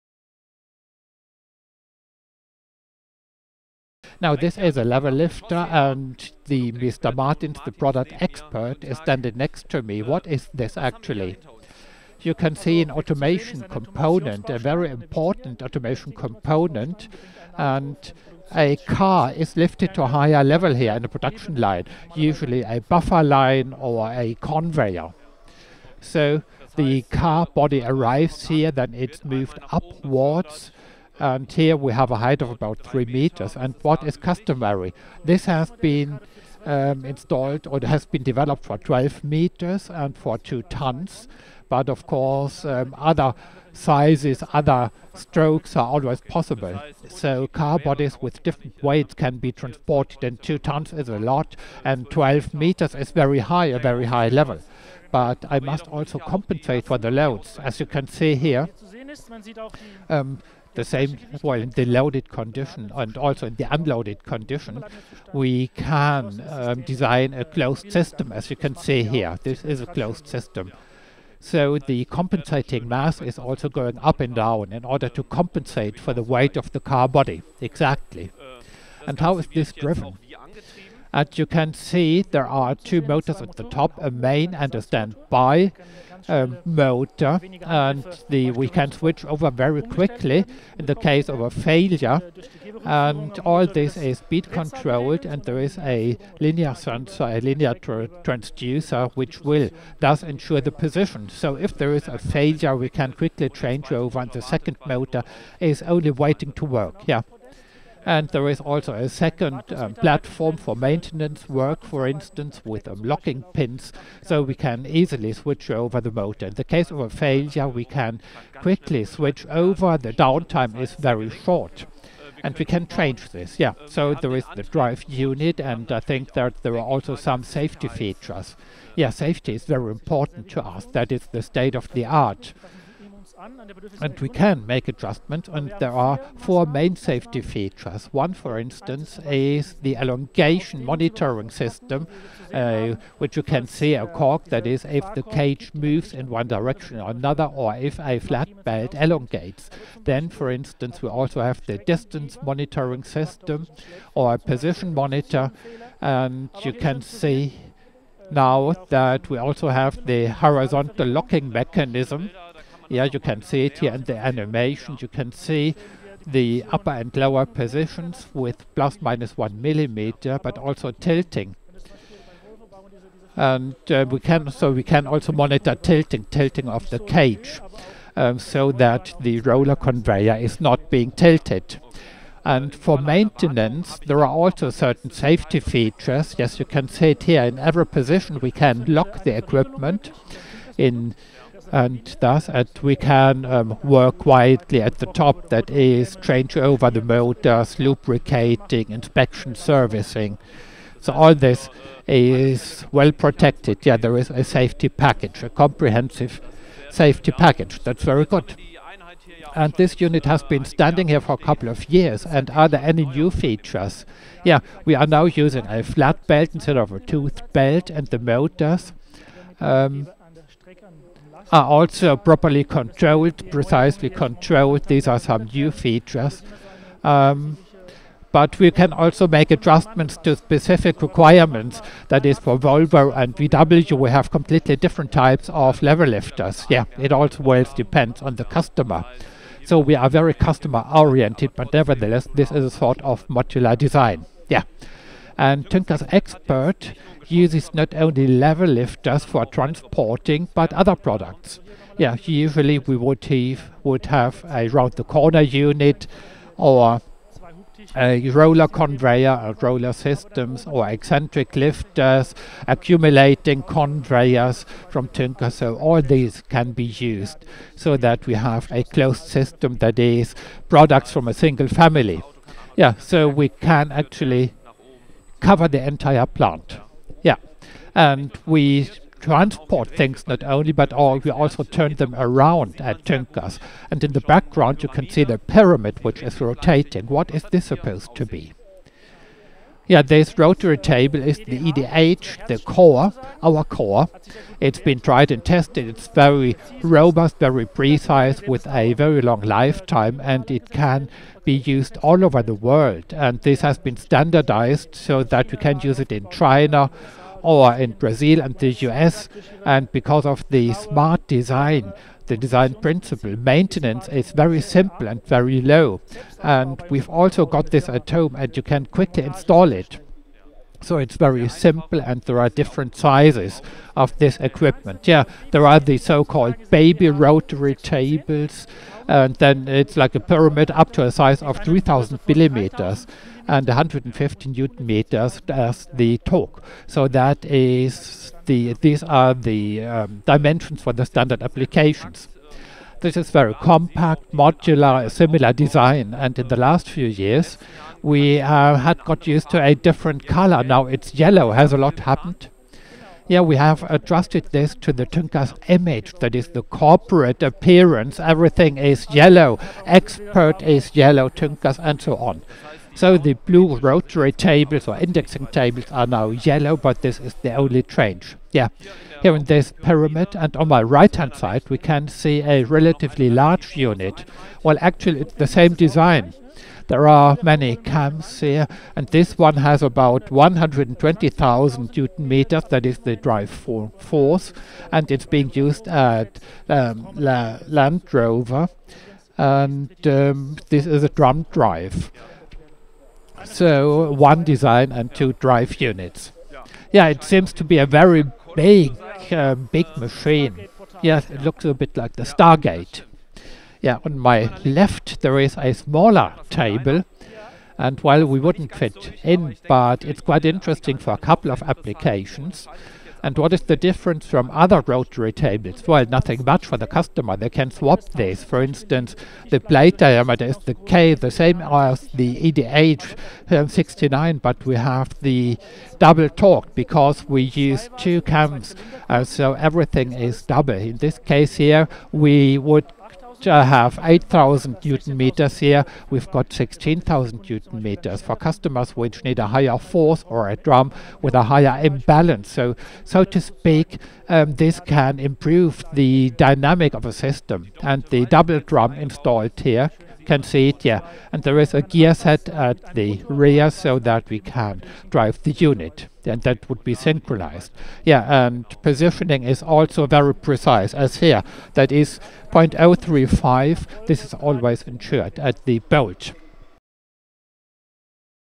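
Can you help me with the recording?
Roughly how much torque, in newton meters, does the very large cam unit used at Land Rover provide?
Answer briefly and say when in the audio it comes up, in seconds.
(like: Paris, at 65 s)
120,000 newton meters, at 380 s.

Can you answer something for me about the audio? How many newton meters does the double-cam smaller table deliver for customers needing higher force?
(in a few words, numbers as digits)
16,000 newton meters.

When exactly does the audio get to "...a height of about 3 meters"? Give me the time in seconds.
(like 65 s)
32 s.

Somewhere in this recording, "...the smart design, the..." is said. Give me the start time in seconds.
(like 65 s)
310 s.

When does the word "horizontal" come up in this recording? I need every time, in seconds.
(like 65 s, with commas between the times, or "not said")
160 s.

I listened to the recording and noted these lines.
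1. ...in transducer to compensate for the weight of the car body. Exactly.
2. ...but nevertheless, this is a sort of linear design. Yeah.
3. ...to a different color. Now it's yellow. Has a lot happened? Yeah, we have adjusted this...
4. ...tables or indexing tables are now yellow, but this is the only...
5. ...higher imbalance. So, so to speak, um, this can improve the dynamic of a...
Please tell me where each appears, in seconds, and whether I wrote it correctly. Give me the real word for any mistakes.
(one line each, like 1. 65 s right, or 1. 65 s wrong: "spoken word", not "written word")
1. 74 s wrong: "order", not "transducer"
2. 241 s wrong: "modular", not "linear"
3. 349 s right
4. 364 s right
5. 441 s right.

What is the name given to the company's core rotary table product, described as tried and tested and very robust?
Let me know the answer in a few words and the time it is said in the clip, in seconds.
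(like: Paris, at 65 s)
EDH, at 291 s.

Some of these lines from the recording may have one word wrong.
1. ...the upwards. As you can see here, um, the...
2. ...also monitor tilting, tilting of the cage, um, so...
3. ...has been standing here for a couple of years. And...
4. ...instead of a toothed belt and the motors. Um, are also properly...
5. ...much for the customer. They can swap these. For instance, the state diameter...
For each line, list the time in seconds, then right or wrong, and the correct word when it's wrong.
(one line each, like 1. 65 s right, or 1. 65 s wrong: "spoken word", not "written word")
1. 56 s wrong: "loads", not "upwards"
2. 175 s right
3. 210 s right
4. 216 s right
5. 416 s wrong: "plate", not "state".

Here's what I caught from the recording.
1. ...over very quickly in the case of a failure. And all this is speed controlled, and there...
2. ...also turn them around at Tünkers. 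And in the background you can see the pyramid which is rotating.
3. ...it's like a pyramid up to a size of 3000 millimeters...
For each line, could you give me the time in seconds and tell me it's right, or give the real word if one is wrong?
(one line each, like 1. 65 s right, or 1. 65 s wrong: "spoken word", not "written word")
1. 89 s right
2. 281 s right
3. 329 s right.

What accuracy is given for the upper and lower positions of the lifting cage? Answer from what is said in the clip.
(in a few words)
plus minus 1 millimeter.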